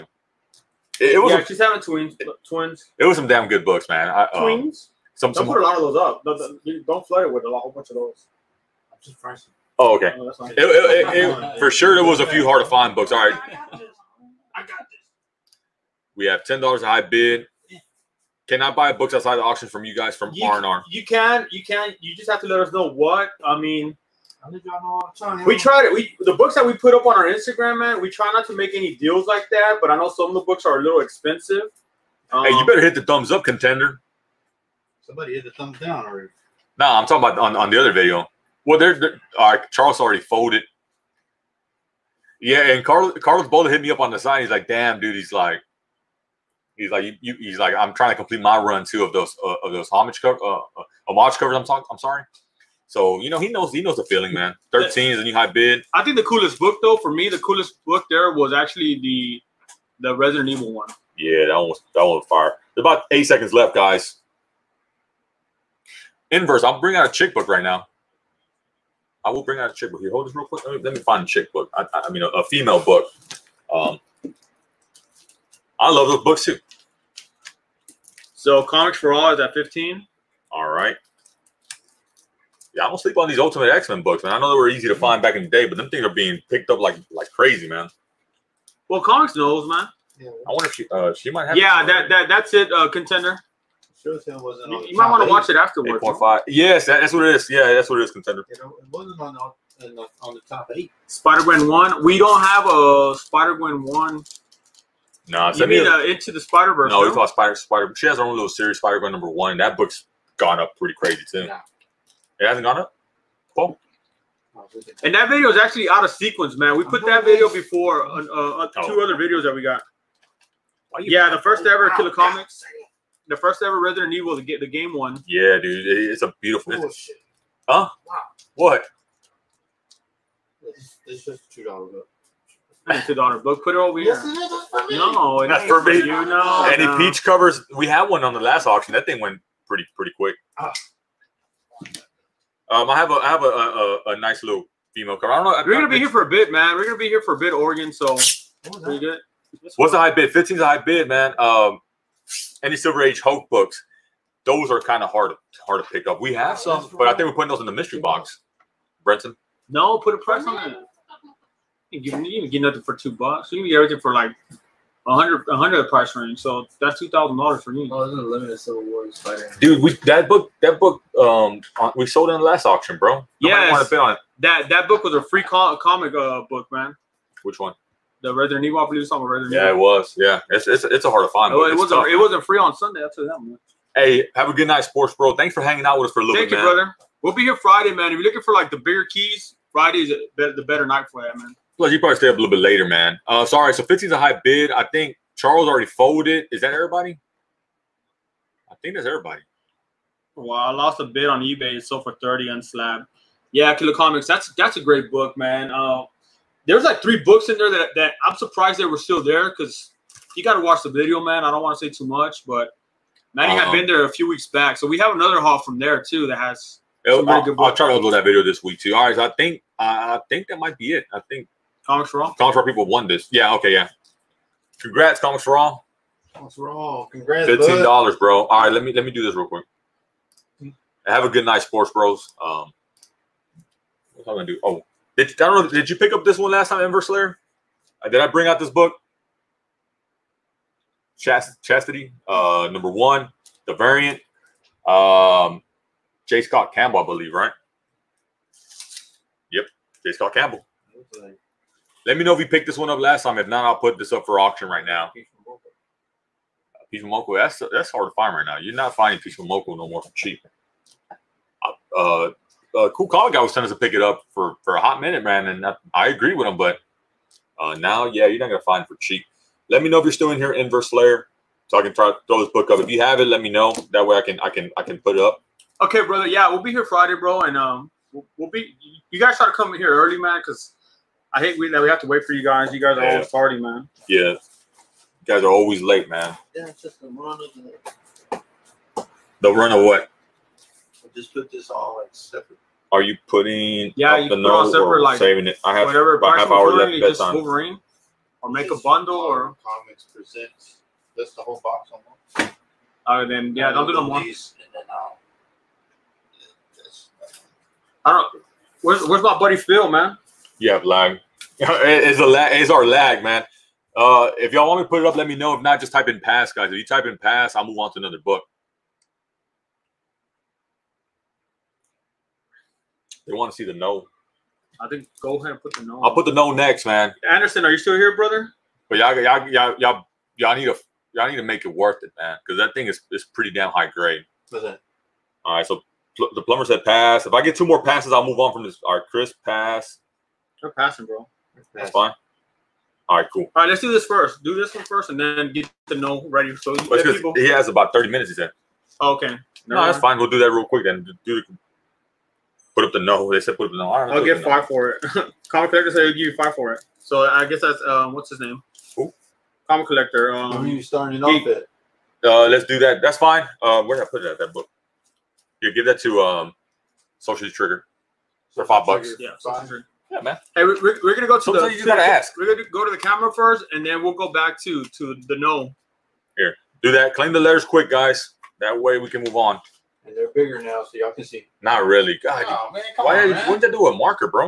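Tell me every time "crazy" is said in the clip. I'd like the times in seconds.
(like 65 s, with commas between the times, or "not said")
87 s, 110 s.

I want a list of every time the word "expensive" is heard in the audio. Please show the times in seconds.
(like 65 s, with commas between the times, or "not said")
31 s.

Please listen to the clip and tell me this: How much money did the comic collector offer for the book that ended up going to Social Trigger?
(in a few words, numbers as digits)
5.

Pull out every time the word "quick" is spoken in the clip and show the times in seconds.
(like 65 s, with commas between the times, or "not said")
70 s, 140 s, 229 s, 350 s, 377 s.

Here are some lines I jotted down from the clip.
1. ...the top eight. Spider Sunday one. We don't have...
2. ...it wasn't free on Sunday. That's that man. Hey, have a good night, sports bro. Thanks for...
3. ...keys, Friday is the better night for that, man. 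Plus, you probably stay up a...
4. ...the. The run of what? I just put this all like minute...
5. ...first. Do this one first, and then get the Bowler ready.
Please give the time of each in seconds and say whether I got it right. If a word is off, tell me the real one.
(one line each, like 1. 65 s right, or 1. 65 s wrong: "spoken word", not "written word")
1. 100 s wrong: "Gwen", not "Sunday"
2. 182 s right
3. 189 s right
4. 287 s wrong: "separate", not "minute"
5. 344 s wrong: "Knull", not "Bowler".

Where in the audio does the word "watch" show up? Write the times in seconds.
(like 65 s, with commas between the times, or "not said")
95 s, 210 s.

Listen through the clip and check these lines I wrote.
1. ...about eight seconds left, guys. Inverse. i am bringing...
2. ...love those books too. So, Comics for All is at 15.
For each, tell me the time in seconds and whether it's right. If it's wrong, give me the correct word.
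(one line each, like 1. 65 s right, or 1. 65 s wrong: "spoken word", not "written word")
1. 62 s right
2. 75 s right.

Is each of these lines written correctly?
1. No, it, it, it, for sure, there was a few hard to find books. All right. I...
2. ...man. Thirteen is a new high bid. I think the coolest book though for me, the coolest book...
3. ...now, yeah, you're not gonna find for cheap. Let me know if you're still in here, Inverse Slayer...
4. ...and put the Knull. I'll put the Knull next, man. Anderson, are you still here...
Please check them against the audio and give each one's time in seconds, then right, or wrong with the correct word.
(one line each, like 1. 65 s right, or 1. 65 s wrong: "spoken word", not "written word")
1. 10 s right
2. 54 s right
3. 267 s right
4. 325 s right.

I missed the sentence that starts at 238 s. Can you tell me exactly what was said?
Uh, did I bring out this book?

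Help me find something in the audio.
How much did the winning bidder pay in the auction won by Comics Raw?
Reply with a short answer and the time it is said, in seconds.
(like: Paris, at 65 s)
$15, at 227 s.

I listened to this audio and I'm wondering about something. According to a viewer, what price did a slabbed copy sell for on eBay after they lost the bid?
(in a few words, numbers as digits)
30.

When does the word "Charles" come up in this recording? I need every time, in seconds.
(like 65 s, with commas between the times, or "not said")
39 s, 195 s.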